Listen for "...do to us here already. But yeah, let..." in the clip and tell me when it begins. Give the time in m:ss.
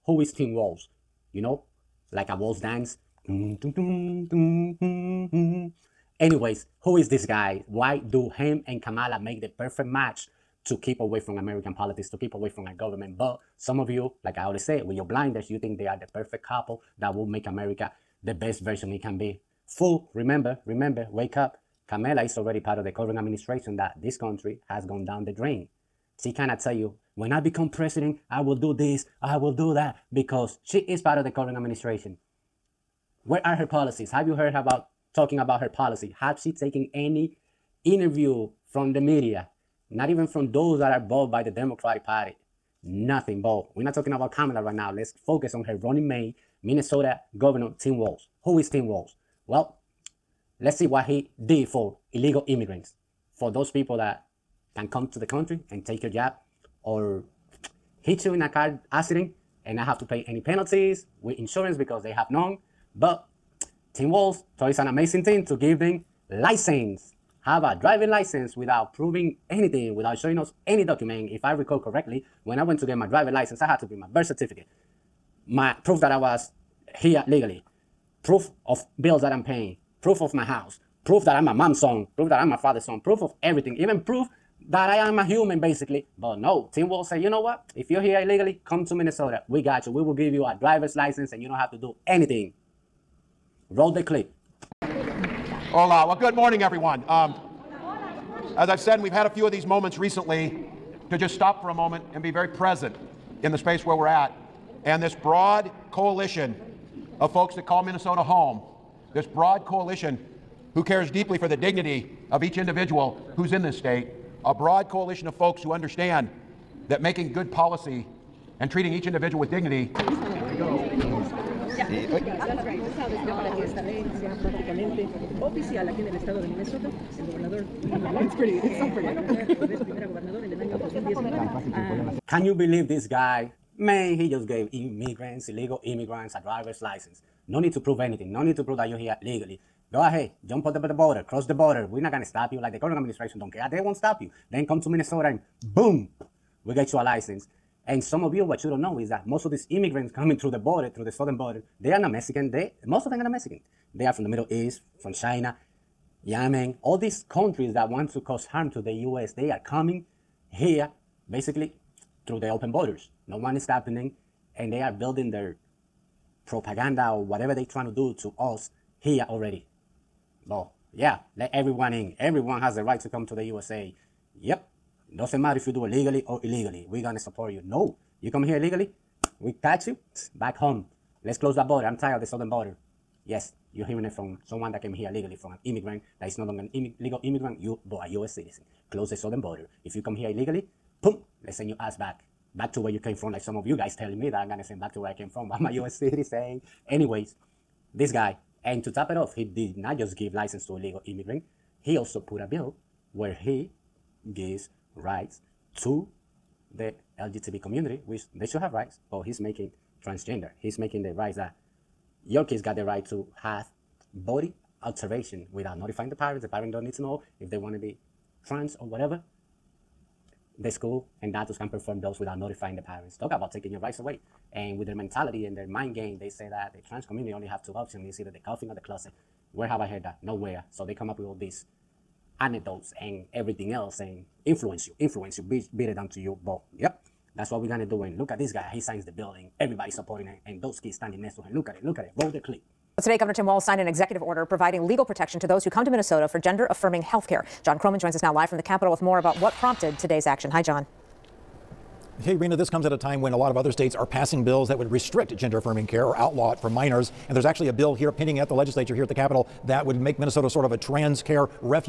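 2:47.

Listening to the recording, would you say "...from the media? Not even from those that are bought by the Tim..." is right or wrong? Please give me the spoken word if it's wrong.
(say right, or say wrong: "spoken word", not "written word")
wrong: "Democratic", not "Tim".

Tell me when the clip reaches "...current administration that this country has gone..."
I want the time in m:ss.
0:22.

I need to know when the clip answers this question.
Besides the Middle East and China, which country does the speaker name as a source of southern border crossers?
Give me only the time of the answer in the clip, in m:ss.
2:36.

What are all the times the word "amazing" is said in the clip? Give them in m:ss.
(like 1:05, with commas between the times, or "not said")
1:04.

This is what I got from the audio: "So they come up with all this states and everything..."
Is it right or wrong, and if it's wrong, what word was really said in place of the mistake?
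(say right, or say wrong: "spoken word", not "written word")
wrong: "anecdotes", not "states".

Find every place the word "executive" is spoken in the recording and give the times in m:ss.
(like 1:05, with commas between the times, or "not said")
4:03.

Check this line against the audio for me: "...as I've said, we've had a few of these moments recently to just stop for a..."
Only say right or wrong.
right.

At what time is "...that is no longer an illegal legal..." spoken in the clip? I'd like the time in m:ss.
3:06.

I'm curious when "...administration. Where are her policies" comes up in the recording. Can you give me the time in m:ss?
0:31.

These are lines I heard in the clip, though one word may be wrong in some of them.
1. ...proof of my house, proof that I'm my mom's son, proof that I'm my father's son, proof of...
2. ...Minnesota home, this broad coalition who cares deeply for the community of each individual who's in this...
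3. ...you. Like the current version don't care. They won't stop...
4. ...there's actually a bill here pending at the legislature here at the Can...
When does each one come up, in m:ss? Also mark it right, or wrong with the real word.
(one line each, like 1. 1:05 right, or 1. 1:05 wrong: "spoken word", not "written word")
1. 1:20 right
2. 1:47 wrong: "dignity", not "community"
3. 2:22 wrong: "administration", not "version"
4. 4:17 wrong: "Capitol", not "Can".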